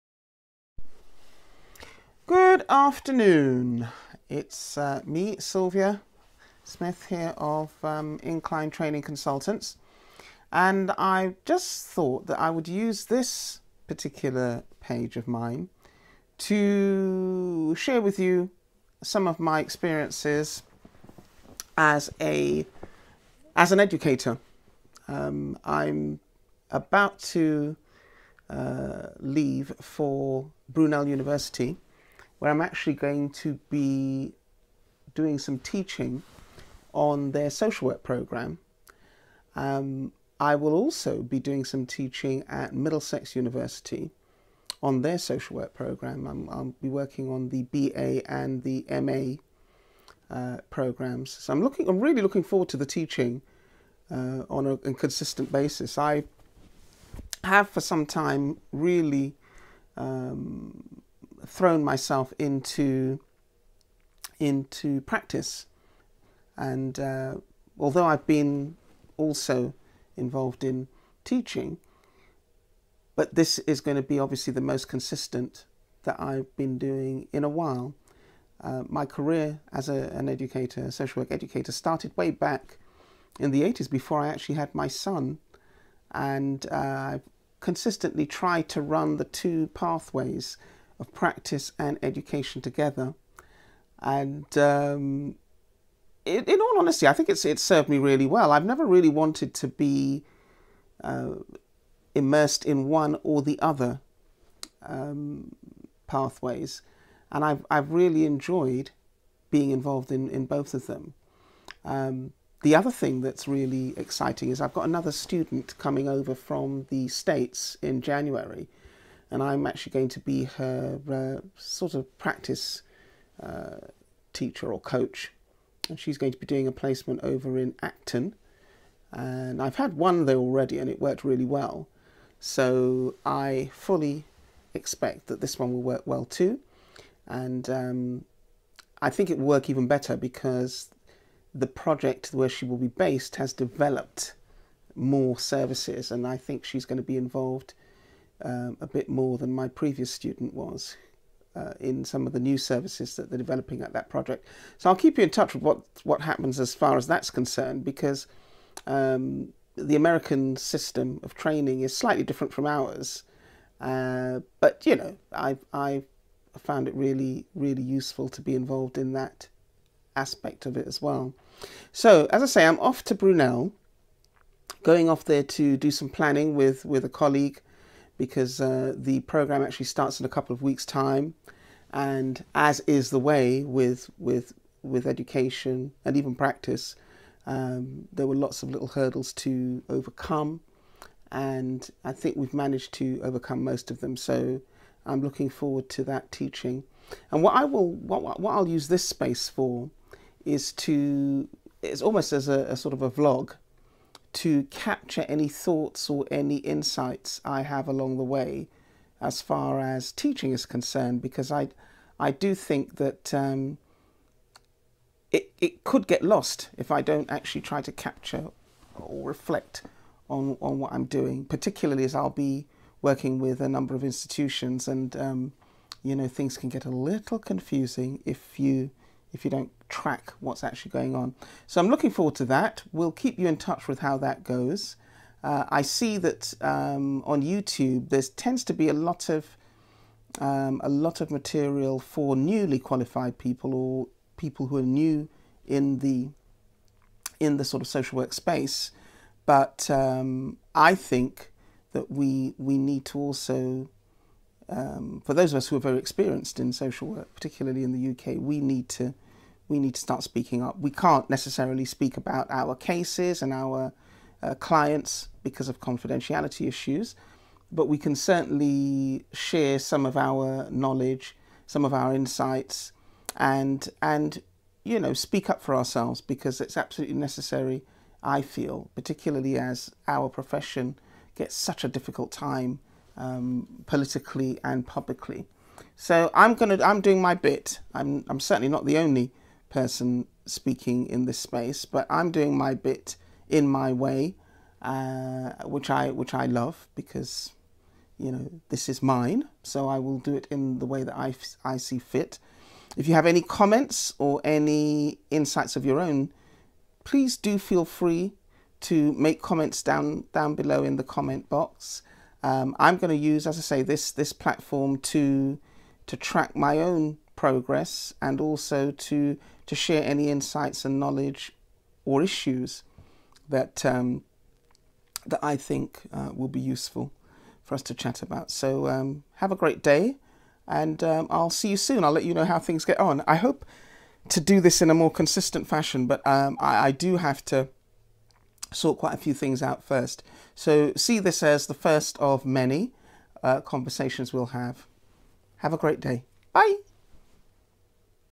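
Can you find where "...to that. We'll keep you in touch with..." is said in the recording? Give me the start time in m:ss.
3:52.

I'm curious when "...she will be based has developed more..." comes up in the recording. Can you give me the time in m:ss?
2:22.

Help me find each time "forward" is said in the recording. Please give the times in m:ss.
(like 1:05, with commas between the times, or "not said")
0:52, 3:15, 3:52.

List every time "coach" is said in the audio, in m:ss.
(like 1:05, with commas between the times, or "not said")
2:04.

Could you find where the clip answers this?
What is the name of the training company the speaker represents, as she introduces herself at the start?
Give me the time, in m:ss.
0:08.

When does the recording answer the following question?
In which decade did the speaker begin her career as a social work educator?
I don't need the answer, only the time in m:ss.
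1:23.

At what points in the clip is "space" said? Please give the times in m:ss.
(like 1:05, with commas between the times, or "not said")
3:19, 4:08, 4:51.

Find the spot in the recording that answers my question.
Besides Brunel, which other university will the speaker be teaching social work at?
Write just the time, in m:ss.
0:42.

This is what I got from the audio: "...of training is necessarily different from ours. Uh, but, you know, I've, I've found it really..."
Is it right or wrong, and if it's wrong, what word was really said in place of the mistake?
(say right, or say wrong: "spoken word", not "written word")
wrong: "slightly", not "necessarily".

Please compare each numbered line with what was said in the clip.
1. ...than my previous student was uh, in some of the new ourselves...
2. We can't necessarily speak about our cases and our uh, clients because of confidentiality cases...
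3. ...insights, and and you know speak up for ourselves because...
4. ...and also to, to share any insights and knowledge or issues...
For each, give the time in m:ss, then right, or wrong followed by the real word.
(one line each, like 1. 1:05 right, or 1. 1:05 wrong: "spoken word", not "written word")
1. 2:29 wrong: "services", not "ourselves"
2. 4:20 wrong: "issues", not "cases"
3. 4:32 right
4. 5:18 right.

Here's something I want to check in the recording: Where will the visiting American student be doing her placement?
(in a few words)
Acton.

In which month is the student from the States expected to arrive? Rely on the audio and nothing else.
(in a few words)
January.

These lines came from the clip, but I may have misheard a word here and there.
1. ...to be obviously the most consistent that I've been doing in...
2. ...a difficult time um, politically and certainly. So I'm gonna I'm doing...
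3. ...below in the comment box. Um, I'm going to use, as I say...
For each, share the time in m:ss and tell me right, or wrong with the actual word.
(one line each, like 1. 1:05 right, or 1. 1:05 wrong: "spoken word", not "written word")
1. 1:13 right
2. 4:41 wrong: "publicly", not "certainly"
3. 5:10 right.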